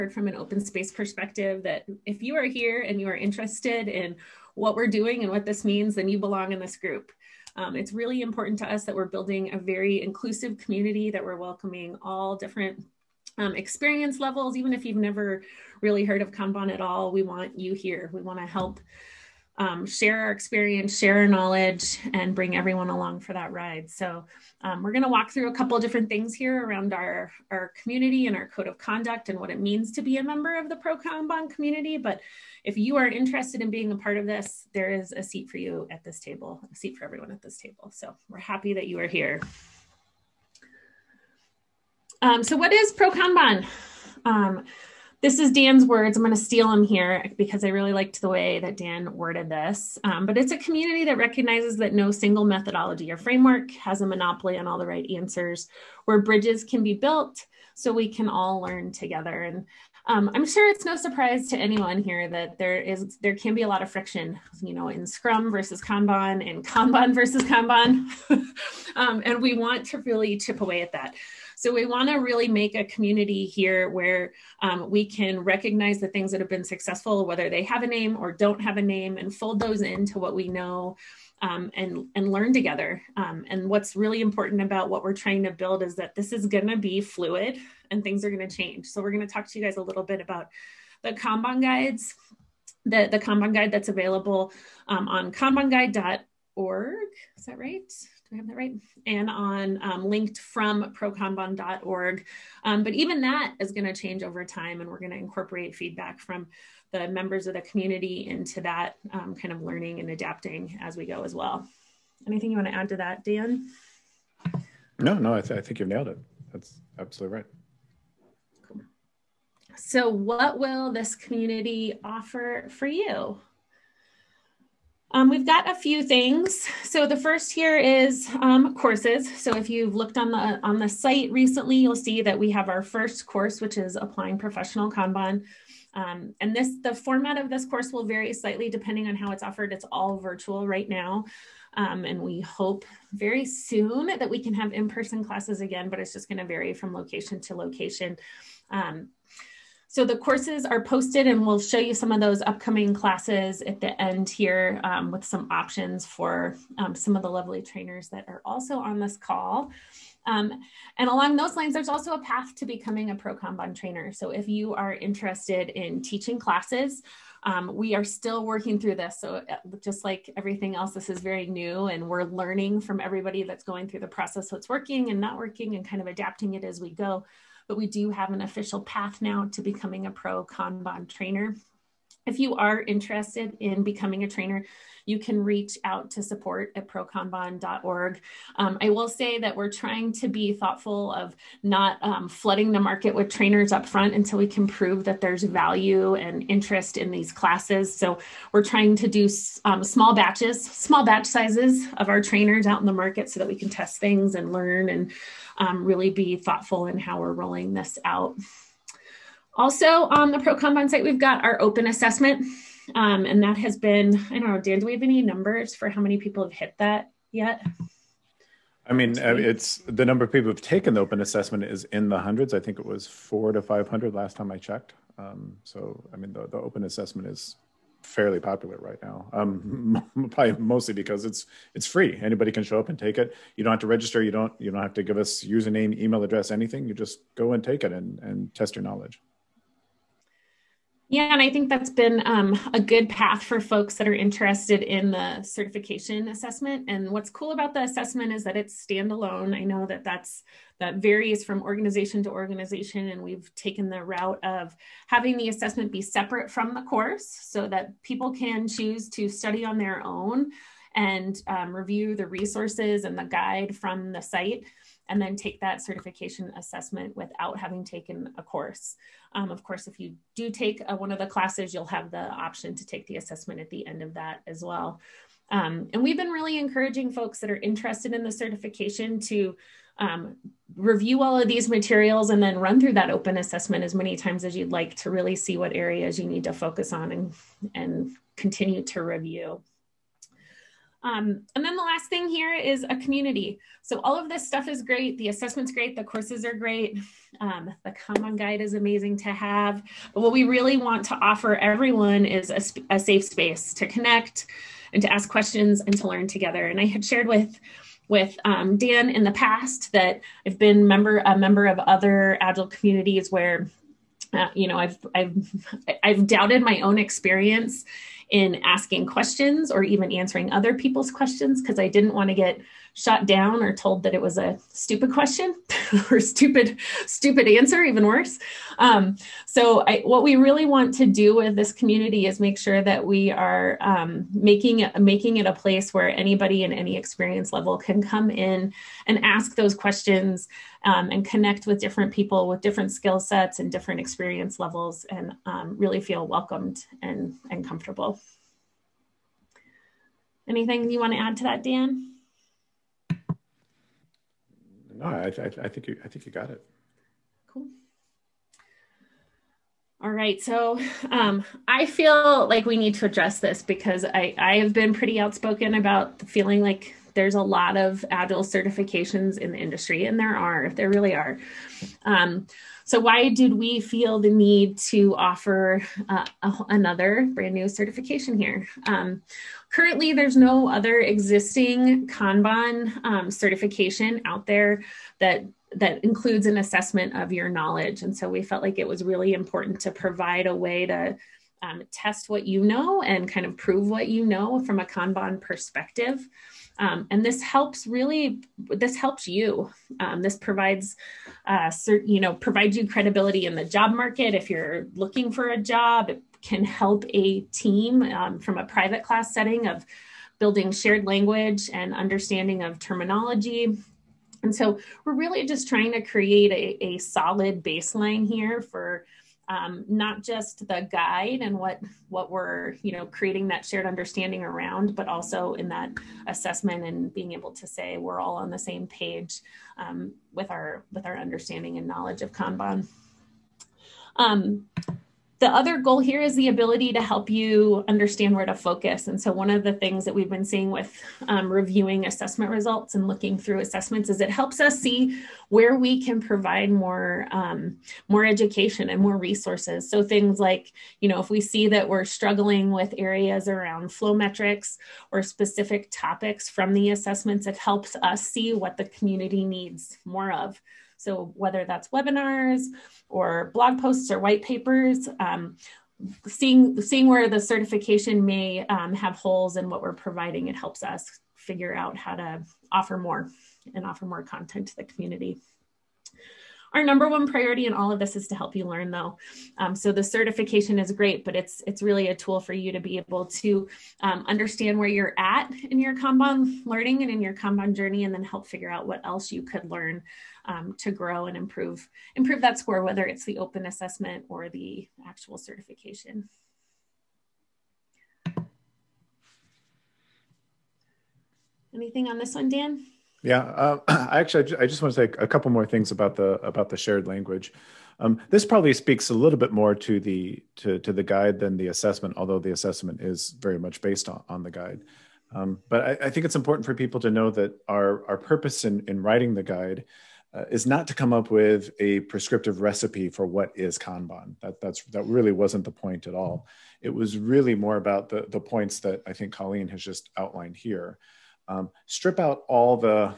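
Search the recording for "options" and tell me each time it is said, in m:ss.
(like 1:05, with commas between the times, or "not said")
2:35, 4:32.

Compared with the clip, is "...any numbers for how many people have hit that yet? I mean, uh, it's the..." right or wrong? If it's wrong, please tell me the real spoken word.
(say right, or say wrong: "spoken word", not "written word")
right.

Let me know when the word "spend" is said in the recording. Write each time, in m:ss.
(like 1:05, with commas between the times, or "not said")
not said.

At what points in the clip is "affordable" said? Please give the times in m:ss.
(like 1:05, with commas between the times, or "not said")
not said.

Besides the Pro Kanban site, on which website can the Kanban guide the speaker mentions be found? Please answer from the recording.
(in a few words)
kanbanguide.org.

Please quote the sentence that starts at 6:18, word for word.
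Um, currently, there's no other existing Kanban um, certification out there that that includes an assessment of your knowledge.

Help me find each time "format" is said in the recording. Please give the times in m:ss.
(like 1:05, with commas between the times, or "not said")
2:16.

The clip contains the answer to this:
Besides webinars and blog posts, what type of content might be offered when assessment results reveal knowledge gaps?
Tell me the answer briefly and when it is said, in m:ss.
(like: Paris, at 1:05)
white papers, at 7:44.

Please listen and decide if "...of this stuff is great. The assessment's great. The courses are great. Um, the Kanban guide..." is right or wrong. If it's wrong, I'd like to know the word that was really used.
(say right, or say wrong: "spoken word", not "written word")
right.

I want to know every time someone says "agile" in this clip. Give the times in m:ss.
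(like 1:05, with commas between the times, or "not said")
5:12, 6:08.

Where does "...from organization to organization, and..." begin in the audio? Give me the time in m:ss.
4:11.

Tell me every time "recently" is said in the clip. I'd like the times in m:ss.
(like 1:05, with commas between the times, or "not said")
2:11.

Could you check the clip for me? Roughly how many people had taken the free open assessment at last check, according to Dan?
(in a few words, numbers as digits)
400 to 500.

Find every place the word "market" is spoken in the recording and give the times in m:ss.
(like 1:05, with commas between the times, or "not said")
3:12, 3:22, 6:43.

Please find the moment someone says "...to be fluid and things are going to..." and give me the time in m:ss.
1:26.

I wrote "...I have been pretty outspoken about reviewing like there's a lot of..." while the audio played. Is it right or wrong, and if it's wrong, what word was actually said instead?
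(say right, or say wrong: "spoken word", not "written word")
wrong: "feeling", not "reviewing".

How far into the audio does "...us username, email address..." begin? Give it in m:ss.
3:55.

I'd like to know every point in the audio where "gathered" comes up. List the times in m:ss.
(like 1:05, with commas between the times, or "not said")
not said.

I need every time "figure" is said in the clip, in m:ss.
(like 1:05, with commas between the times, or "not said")
7:51, 8:08.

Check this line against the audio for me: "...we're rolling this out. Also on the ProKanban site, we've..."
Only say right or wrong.
right.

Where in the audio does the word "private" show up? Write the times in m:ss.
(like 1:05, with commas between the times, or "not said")
6:48.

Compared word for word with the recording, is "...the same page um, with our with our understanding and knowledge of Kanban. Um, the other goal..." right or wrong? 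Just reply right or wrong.
right.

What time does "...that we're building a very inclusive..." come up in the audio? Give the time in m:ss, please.
0:08.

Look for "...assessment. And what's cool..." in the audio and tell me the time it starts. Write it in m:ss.
4:06.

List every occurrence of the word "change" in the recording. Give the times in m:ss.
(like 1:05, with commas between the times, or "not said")
1:28, 1:43.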